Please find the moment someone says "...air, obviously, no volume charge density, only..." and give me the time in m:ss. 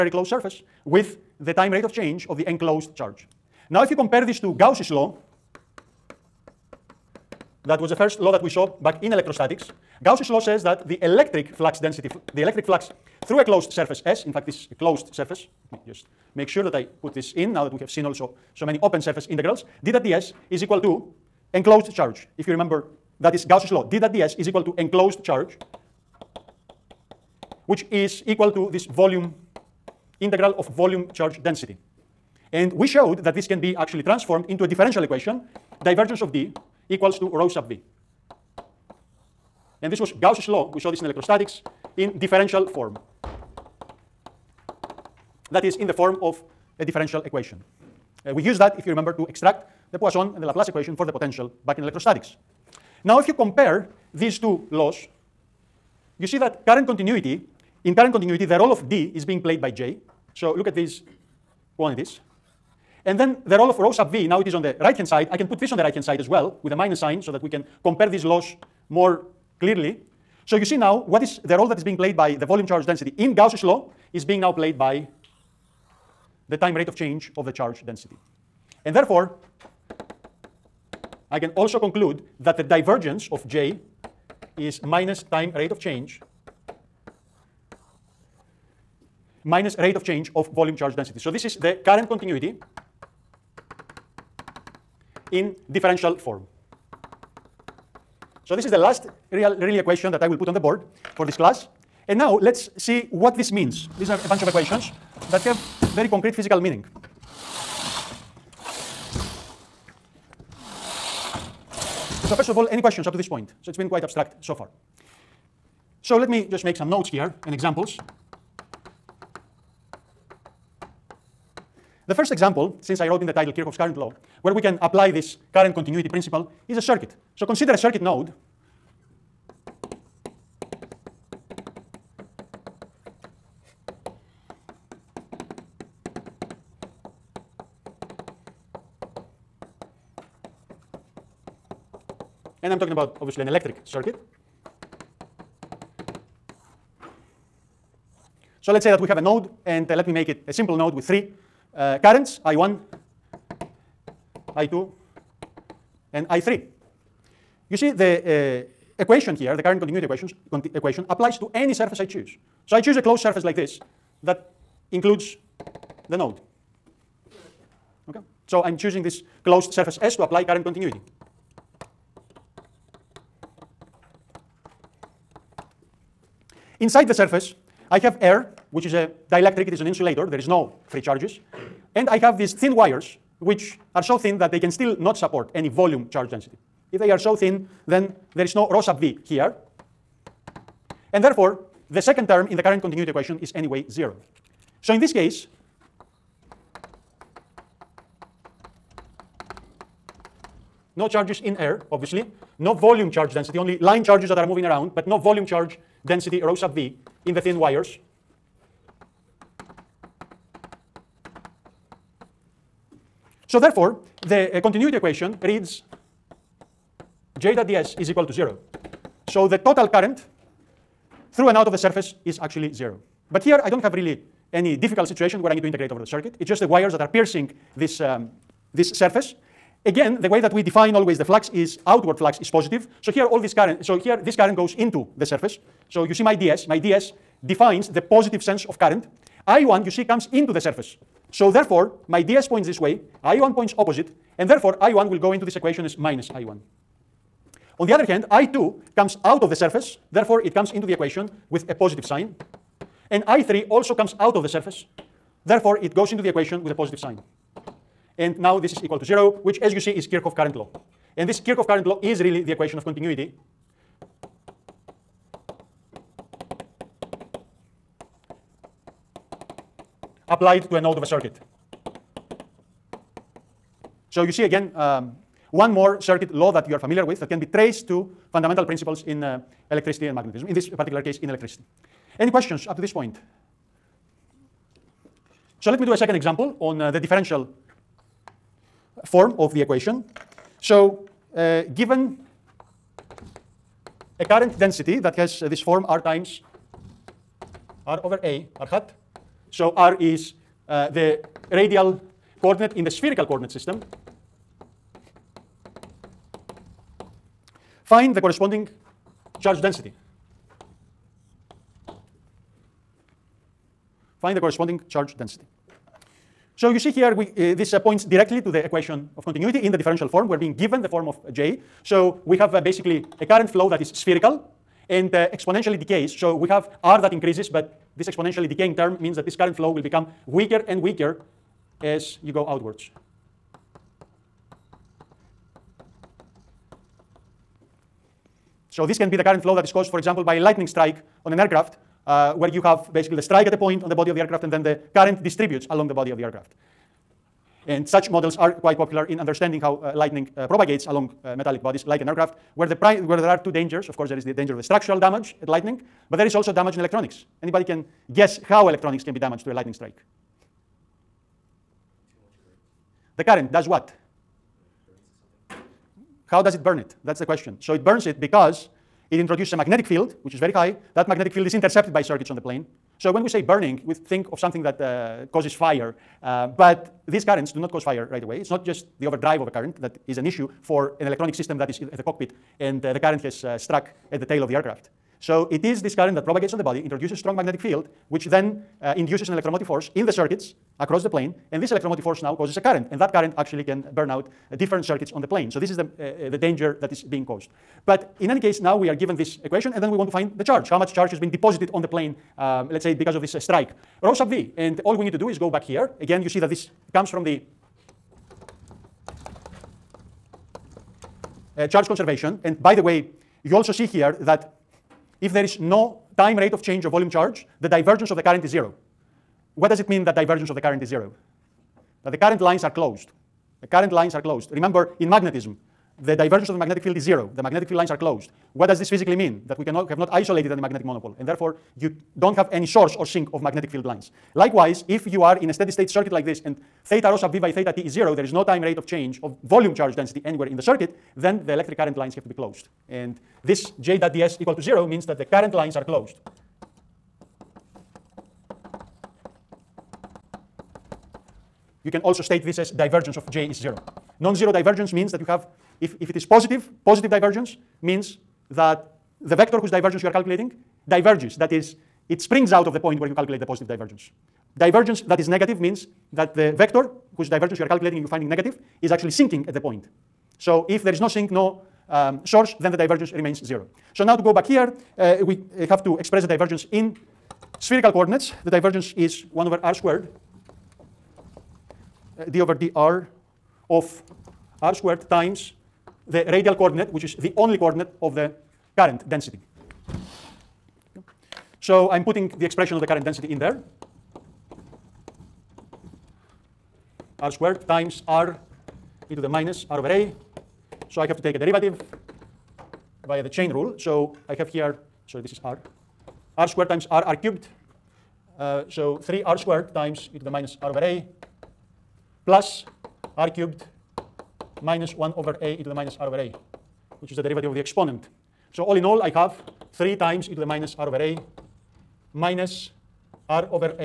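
3:21.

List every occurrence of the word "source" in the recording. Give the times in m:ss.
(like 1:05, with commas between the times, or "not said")
7:12, 7:52.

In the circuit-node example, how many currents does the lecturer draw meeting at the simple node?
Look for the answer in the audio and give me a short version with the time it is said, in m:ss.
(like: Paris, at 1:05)
3, at 2:31.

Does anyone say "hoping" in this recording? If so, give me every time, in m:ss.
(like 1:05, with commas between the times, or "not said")
not said.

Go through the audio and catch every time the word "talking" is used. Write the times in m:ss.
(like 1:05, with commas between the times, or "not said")
2:22.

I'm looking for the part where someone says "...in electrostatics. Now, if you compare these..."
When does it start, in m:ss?
0:51.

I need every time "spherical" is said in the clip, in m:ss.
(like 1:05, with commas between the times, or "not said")
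5:02, 5:23, 7:57.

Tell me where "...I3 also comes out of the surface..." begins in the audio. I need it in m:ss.
4:13.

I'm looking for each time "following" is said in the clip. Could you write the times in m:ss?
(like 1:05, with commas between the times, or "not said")
not said.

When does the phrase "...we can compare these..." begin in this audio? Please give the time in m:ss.
1:07.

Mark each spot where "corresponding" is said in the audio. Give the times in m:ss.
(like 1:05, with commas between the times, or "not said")
5:08, 5:14.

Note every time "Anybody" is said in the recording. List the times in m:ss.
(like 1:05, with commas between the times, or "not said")
5:57.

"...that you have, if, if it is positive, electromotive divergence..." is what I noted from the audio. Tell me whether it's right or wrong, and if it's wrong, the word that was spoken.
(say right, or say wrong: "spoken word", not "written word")
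wrong: "positive", not "electromotive".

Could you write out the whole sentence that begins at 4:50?
So uh, given a current density that has uh, this form R times R over A, R hat.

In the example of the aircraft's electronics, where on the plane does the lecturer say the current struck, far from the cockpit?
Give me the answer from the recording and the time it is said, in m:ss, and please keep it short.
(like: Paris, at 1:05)
the tail, at 6:24.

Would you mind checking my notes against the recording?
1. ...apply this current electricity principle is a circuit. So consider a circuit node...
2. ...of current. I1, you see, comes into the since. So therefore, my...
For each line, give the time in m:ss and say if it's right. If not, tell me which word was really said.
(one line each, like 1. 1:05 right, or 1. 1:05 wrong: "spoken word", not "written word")
1. 2:04 wrong: "continuity", not "electricity"
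2. 3:58 wrong: "surface", not "since".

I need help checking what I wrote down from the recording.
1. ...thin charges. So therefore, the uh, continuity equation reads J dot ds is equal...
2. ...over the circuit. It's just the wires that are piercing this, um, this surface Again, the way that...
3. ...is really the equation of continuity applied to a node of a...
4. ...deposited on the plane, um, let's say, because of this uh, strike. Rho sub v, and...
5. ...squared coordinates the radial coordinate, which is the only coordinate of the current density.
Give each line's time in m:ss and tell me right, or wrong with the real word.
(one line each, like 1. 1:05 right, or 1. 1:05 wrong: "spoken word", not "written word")
1. 3:27 wrong: "wires", not "charges"
2. 3:45 right
3. 4:22 right
4. 6:41 right
5. 8:04 wrong: "times", not "coordinates".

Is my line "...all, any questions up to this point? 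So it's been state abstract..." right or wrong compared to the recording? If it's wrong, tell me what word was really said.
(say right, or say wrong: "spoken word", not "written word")
wrong: "quite", not "state".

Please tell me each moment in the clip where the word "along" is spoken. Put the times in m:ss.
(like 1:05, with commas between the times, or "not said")
5:45, 5:50.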